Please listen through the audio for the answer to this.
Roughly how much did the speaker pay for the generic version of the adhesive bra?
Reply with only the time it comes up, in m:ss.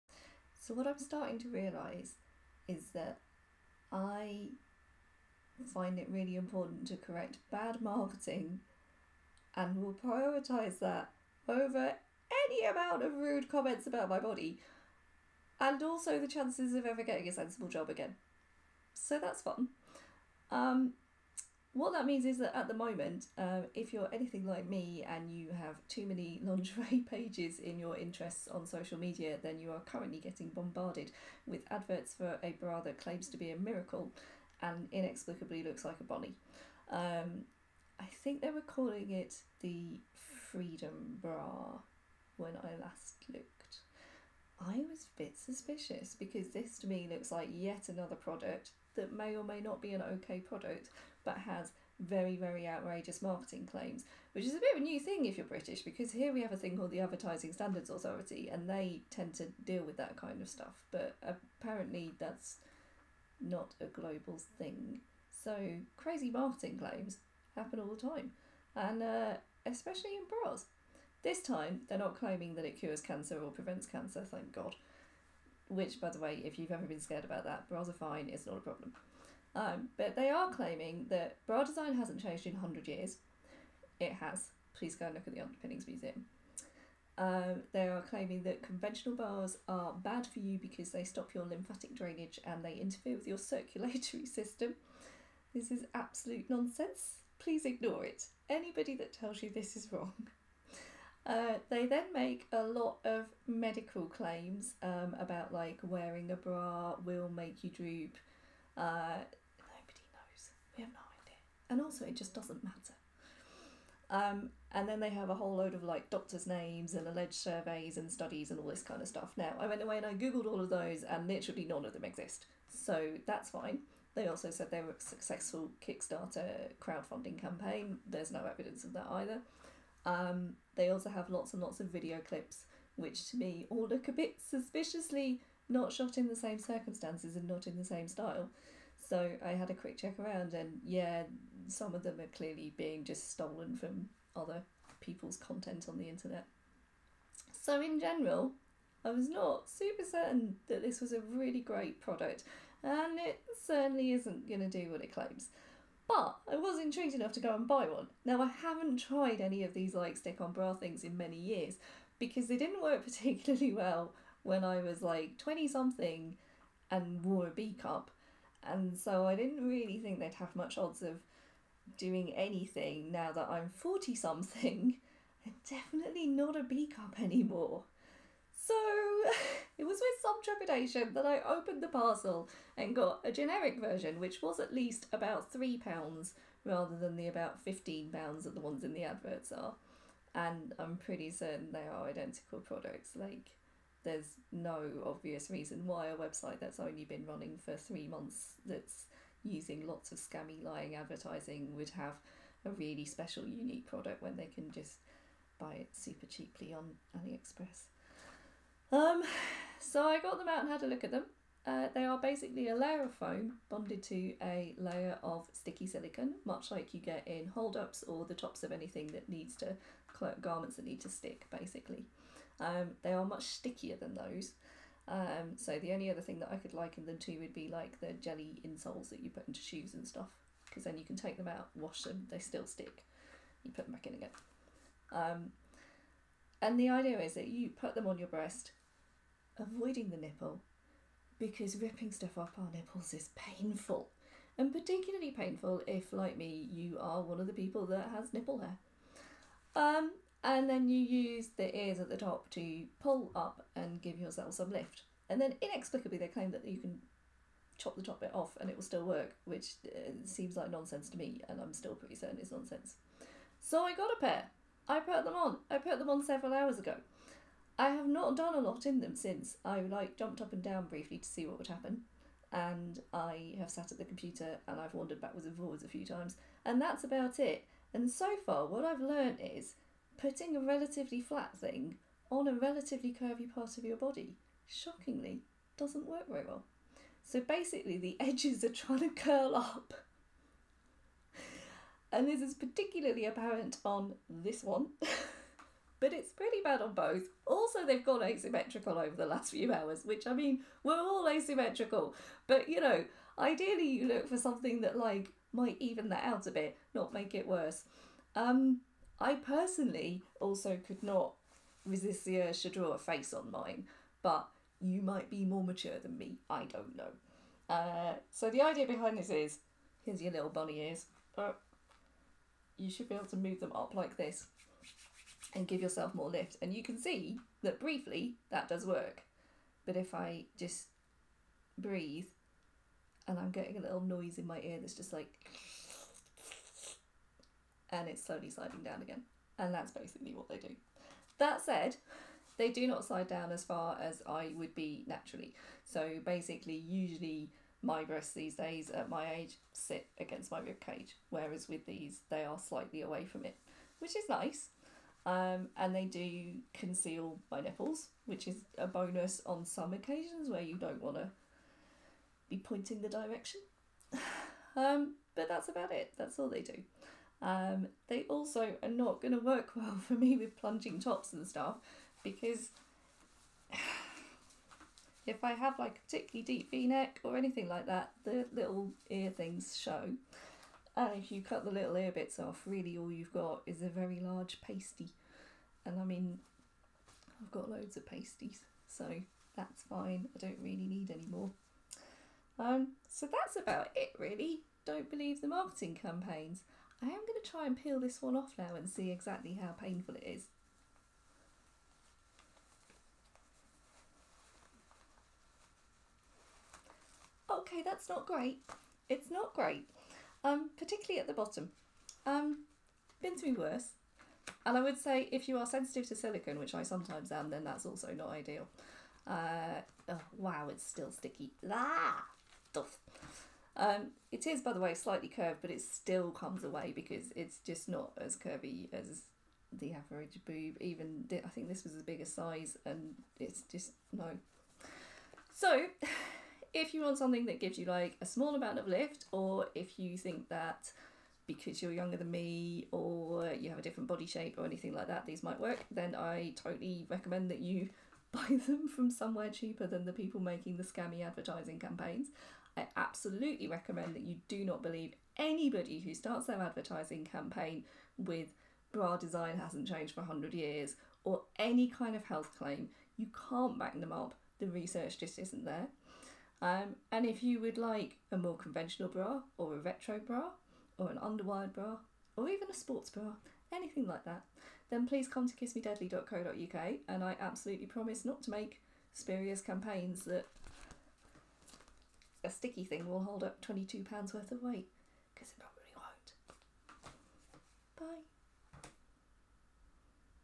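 3:05.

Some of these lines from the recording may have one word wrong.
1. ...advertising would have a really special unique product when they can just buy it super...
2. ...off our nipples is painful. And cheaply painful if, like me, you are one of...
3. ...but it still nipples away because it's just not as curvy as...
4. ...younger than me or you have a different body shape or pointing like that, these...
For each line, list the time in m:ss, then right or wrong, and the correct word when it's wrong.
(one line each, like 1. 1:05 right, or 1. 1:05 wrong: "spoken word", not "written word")
1. 3:20 right
2. 4:02 wrong: "particularly", not "cheaply"
3. 7:05 wrong: "comes", not "nipples"
4. 7:21 wrong: "anything", not "pointing".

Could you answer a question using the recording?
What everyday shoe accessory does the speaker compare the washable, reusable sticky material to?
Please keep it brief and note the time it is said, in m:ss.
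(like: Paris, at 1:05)
jelly insoles, at 3:48.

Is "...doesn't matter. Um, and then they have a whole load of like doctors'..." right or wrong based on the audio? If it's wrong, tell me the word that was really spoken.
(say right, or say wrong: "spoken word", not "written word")
right.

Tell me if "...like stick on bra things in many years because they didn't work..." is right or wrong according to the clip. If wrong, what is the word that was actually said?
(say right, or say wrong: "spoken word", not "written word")
right.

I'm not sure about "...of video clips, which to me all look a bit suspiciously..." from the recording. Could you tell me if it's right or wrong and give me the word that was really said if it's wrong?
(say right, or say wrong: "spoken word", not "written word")
right.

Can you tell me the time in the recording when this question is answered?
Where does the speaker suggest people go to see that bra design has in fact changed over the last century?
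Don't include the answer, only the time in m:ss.
1:25.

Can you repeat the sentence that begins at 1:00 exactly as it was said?
But apparently, that's not a global thing.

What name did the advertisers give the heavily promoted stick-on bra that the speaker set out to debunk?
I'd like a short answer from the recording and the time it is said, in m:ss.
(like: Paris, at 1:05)
Freedom Bra, at 0:40.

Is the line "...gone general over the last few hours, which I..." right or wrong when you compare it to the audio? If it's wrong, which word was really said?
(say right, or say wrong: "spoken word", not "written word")
wrong: "asymmetrical", not "general".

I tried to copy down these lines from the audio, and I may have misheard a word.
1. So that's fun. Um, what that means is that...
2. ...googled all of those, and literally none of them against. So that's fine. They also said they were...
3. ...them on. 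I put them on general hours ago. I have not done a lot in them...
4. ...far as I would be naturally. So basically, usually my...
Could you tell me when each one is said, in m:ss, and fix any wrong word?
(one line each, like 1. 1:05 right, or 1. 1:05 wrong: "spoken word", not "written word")
1. 0:18 right
2. 2:00 wrong: "exist", not "against"
3. 4:25 wrong: "several", not "general"
4. 5:43 right.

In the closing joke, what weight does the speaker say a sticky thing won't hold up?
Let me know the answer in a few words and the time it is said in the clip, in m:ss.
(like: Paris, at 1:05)
£22, at 8:03.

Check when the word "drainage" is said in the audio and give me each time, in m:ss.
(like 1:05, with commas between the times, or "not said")
1:31.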